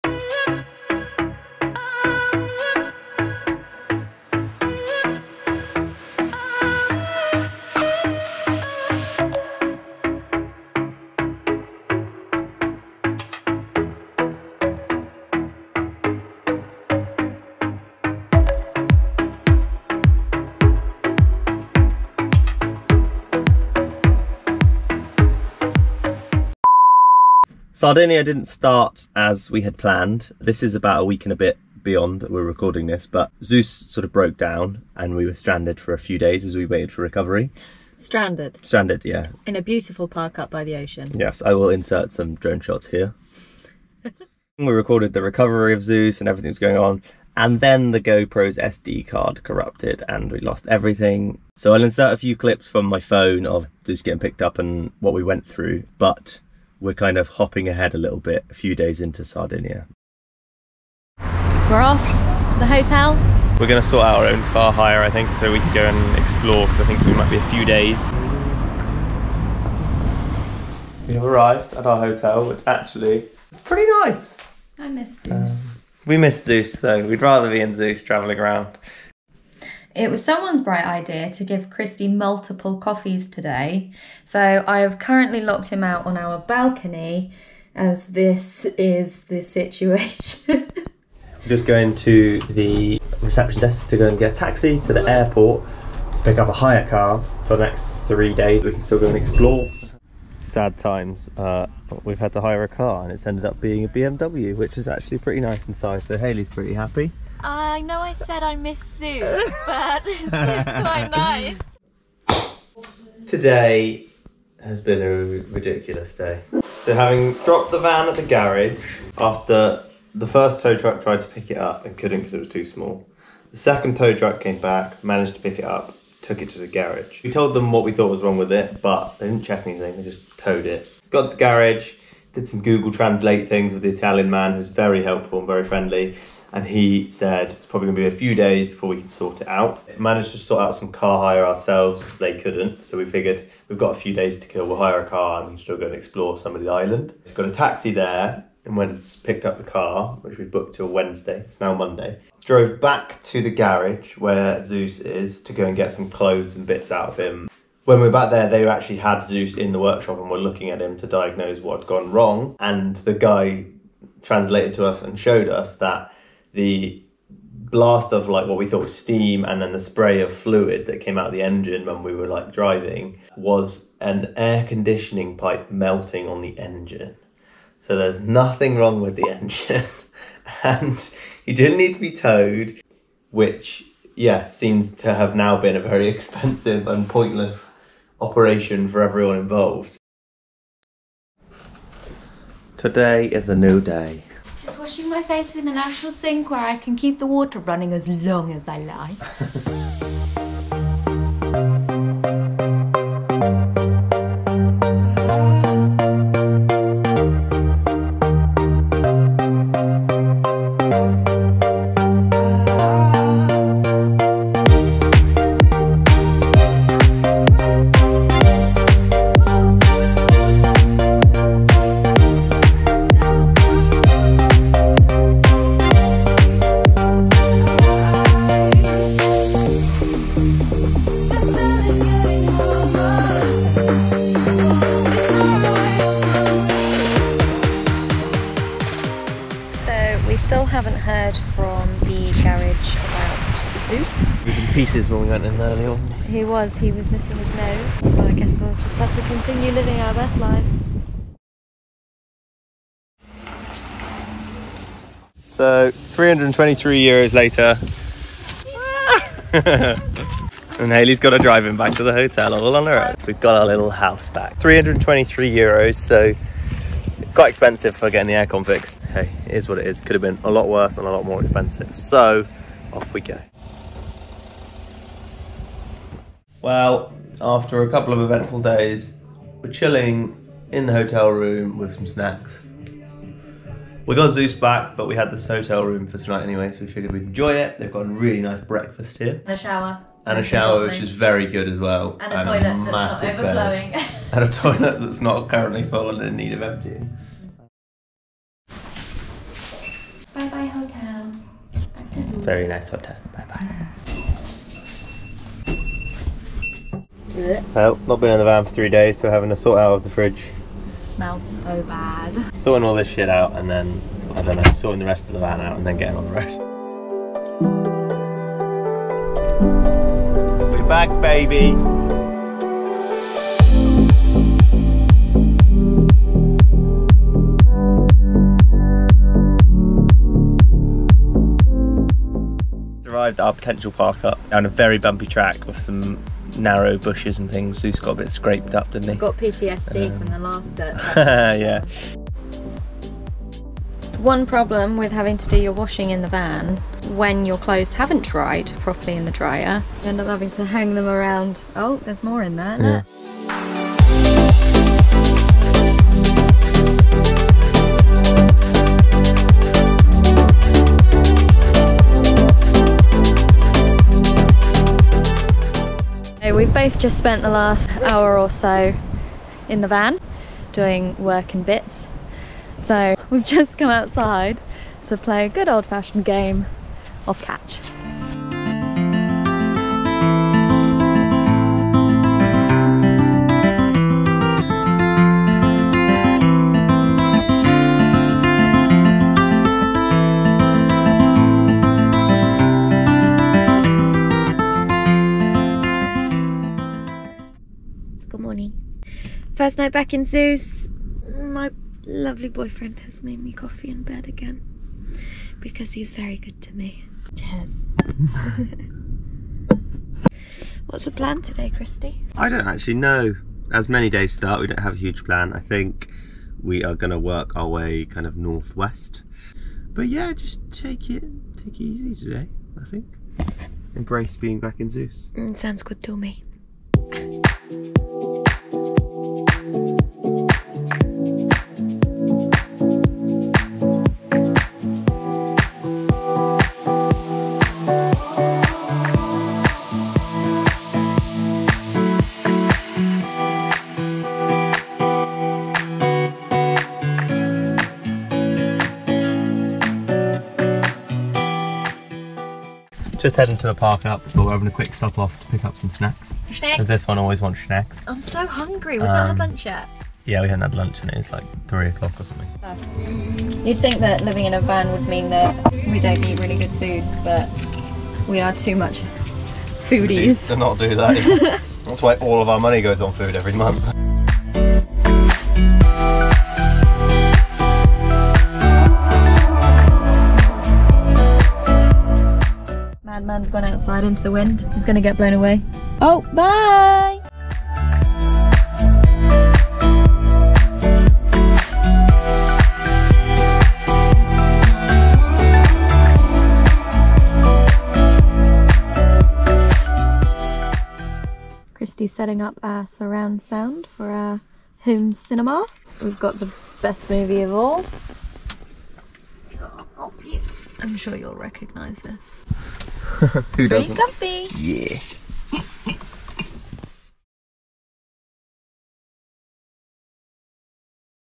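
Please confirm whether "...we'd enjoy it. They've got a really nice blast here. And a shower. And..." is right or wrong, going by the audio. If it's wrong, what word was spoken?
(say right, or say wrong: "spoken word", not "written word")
wrong: "breakfast", not "blast".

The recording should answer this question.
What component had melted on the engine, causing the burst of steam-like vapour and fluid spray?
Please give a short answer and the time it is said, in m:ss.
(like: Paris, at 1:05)
air conditioning pipe, at 2:54.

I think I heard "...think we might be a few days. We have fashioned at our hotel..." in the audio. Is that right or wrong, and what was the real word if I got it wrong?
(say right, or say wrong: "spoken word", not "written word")
wrong: "arrived", not "fashioned".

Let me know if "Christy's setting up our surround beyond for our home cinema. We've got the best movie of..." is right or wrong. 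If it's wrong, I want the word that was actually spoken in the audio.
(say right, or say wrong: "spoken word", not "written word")
wrong: "sound", not "beyond".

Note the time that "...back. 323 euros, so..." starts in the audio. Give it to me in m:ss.
4:24.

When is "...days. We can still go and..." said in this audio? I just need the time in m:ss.
1:38.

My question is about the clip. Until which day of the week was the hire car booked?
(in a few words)
Wednesday.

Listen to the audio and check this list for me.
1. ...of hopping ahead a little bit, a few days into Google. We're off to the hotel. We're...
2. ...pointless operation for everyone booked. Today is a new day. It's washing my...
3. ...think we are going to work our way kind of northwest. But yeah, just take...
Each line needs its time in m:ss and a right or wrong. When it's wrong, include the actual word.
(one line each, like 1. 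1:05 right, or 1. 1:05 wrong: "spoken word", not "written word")
1. 0:57 wrong: "Sardinia", not "Google"
2. 3:07 wrong: "involved", not "booked"
3. 6:55 right.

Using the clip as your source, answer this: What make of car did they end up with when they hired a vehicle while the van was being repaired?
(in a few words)
BMW.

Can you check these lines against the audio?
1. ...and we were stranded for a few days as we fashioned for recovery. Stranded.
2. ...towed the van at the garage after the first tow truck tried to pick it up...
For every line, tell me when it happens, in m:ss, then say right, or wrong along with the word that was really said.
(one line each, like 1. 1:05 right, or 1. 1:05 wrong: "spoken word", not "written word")
1. 0:34 wrong: "waited", not "fashioned"
2. 1:57 wrong: "dropped", not "towed".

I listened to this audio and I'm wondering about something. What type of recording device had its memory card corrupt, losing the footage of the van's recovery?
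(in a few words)
GoPro.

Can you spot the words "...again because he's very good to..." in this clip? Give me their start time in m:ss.
6:44.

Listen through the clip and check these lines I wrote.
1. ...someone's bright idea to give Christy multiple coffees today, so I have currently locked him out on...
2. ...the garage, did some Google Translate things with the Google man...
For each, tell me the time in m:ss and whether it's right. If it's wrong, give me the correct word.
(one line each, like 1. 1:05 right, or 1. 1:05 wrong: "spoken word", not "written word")
1. 1:20 right
2. 2:11 wrong: "Italian", not "Google".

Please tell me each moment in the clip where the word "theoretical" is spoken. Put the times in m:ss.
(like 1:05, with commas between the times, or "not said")
not said.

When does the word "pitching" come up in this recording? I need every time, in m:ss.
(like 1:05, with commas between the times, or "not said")
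not said.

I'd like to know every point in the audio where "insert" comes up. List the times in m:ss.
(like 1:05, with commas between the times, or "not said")
0:41, 0:51.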